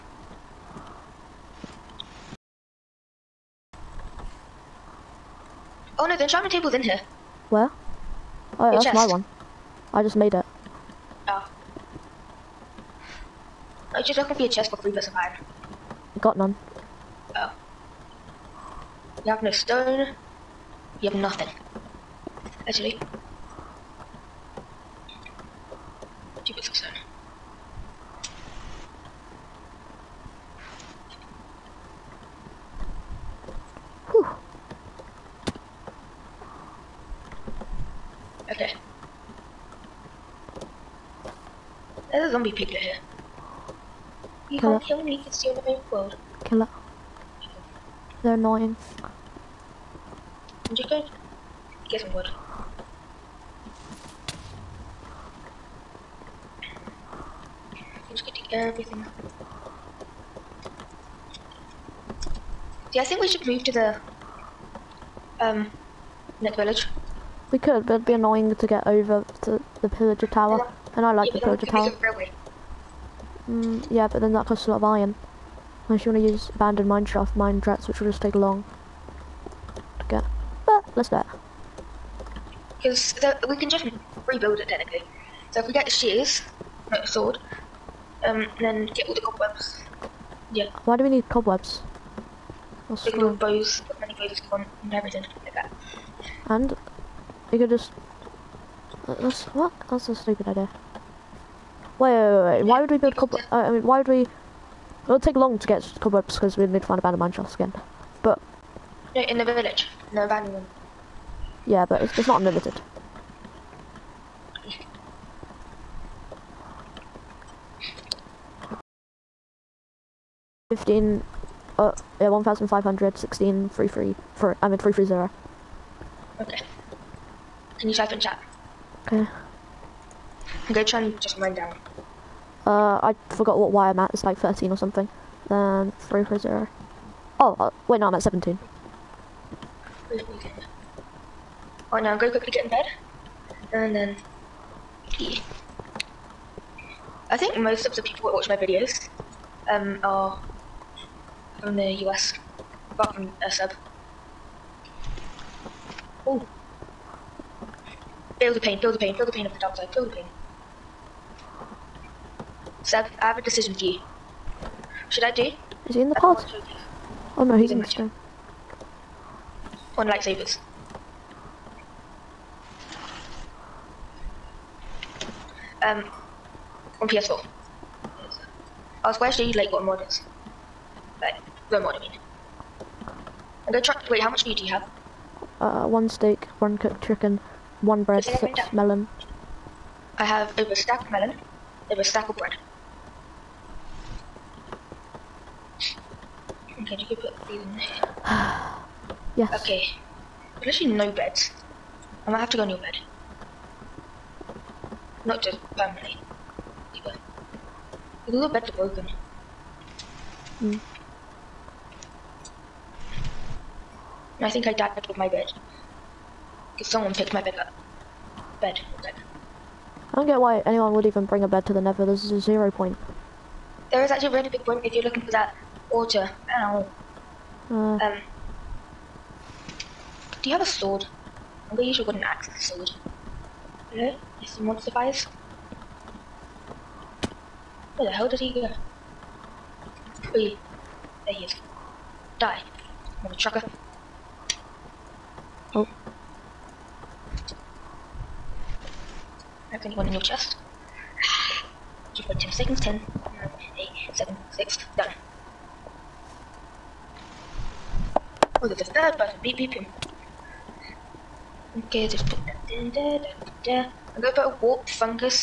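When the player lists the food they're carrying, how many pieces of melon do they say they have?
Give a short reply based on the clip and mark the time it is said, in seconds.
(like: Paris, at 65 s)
6, at 188 s.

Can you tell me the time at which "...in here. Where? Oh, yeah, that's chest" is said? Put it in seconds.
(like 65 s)
6 s.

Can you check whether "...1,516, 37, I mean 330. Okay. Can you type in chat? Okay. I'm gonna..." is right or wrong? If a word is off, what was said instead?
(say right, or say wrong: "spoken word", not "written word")
wrong: "33", not "37".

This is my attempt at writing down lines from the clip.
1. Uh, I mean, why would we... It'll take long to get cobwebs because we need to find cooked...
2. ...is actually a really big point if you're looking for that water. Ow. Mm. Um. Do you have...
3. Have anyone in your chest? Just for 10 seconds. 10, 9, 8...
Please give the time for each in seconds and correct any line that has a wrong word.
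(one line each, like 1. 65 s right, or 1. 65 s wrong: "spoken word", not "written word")
1. 103 s wrong: "abandoned", not "cooked"
2. 224 s right
3. 249 s right.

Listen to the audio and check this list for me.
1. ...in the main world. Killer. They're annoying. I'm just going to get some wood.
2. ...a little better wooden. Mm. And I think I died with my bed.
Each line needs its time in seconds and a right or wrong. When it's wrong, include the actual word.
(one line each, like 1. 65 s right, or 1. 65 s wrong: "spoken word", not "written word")
1. 45 s right
2. 208 s wrong: "broken", not "wooden".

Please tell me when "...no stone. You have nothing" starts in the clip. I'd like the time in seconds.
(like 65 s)
19 s.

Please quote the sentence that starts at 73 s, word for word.
Mm, yeah, but then that costs a lot of iron.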